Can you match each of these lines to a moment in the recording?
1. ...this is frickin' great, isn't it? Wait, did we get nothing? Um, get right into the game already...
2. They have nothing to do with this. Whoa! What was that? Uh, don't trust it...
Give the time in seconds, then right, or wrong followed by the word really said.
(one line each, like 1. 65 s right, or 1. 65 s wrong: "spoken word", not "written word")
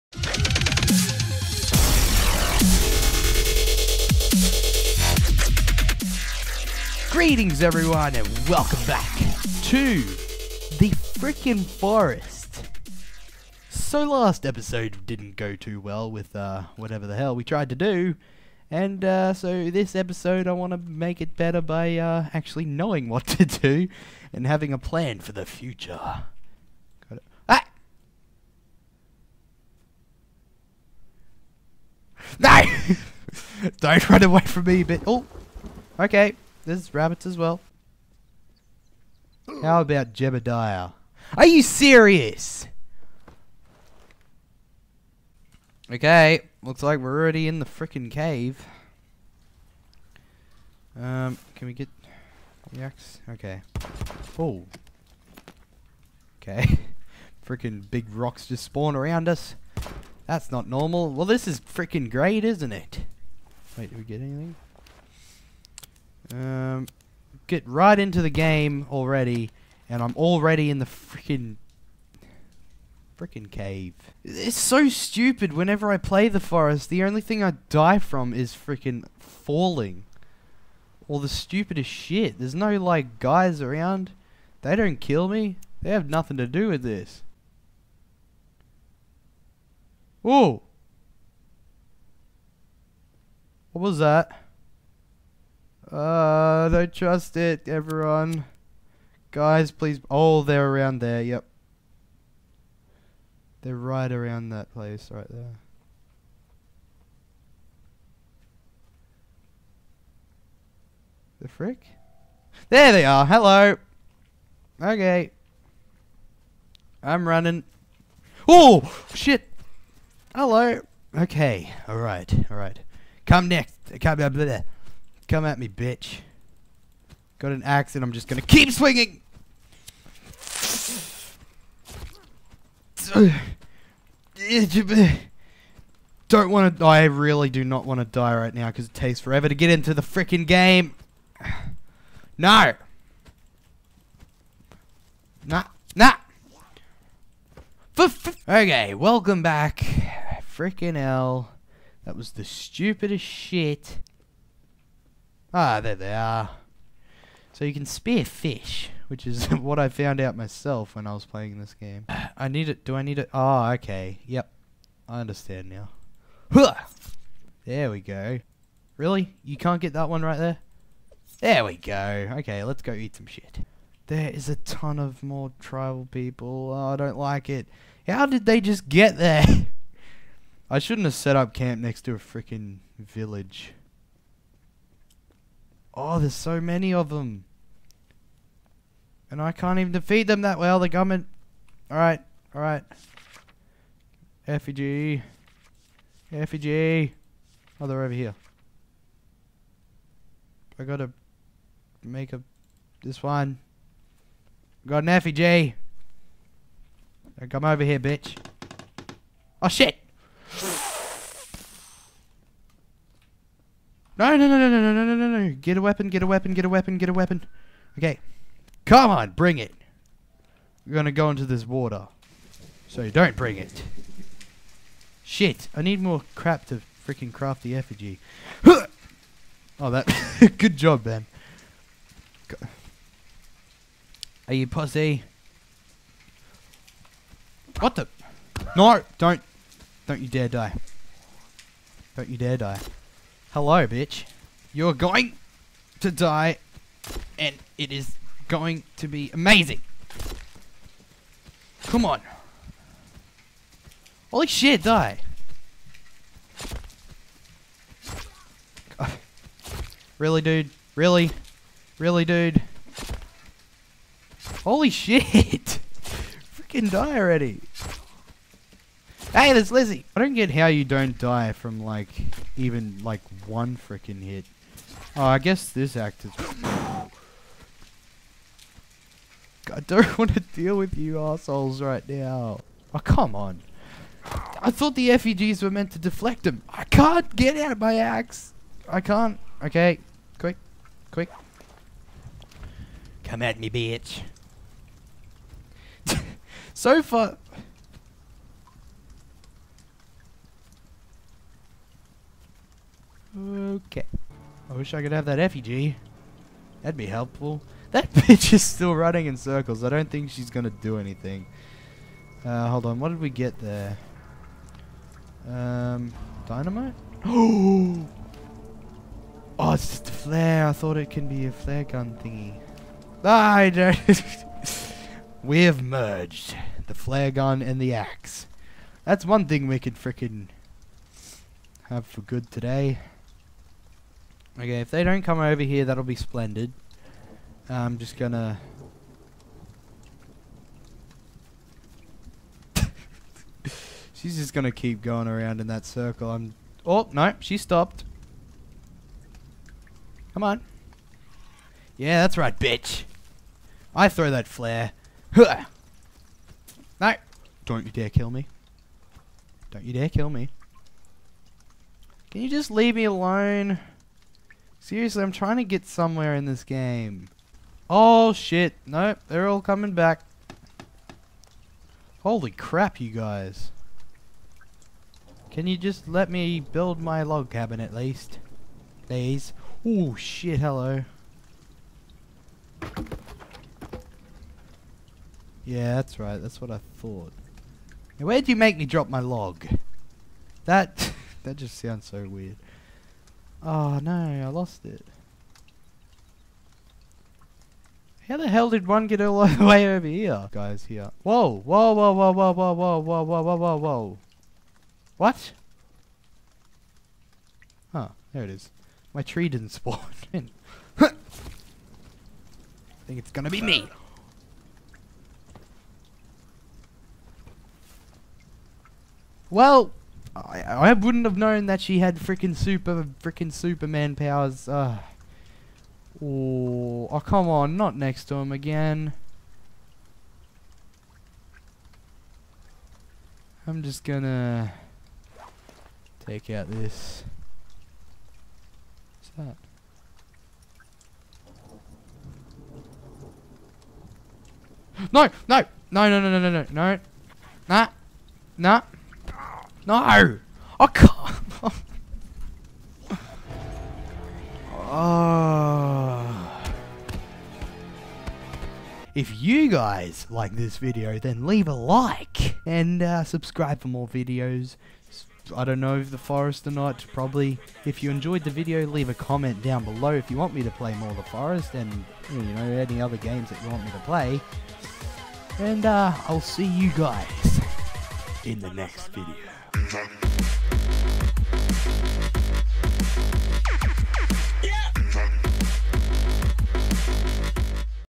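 1. 61 s wrong: "anything", not "nothing"
2. 85 s right.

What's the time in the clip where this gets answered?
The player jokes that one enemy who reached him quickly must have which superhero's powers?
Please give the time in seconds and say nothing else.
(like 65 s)
423 s.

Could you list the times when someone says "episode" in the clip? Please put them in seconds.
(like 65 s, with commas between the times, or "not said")
14 s, 19 s.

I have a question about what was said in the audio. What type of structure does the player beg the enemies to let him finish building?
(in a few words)
Log cabin.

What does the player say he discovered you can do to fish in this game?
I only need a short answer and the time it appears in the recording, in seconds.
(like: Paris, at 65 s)
Spear fish, at 157 s.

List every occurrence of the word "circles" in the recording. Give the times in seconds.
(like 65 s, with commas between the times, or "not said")
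309 s, 345 s.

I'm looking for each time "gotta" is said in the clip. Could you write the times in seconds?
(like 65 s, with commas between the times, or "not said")
200 s.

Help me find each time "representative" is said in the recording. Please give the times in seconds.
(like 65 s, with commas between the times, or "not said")
not said.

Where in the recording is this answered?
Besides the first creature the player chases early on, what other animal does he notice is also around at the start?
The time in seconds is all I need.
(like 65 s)
36 s.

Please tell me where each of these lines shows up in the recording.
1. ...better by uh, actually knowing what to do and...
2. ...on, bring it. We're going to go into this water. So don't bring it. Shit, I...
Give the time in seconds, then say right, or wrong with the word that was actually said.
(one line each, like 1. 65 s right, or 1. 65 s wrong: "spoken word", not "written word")
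1. 21 s right
2. 219 s right.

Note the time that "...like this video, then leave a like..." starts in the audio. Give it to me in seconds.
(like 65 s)
460 s.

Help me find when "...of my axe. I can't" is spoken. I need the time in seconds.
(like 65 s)
287 s.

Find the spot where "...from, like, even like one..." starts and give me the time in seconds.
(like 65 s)
271 s.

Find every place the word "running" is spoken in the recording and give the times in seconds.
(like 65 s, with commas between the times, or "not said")
117 s, 308 s.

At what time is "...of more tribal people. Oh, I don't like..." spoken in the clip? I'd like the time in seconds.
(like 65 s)
174 s.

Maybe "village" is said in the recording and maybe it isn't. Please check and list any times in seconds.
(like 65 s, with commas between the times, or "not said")
182 s.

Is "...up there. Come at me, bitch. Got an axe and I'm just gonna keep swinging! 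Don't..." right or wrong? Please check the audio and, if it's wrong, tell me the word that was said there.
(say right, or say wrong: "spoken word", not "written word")
right.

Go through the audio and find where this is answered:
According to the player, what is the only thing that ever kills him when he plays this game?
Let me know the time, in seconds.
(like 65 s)
79 s.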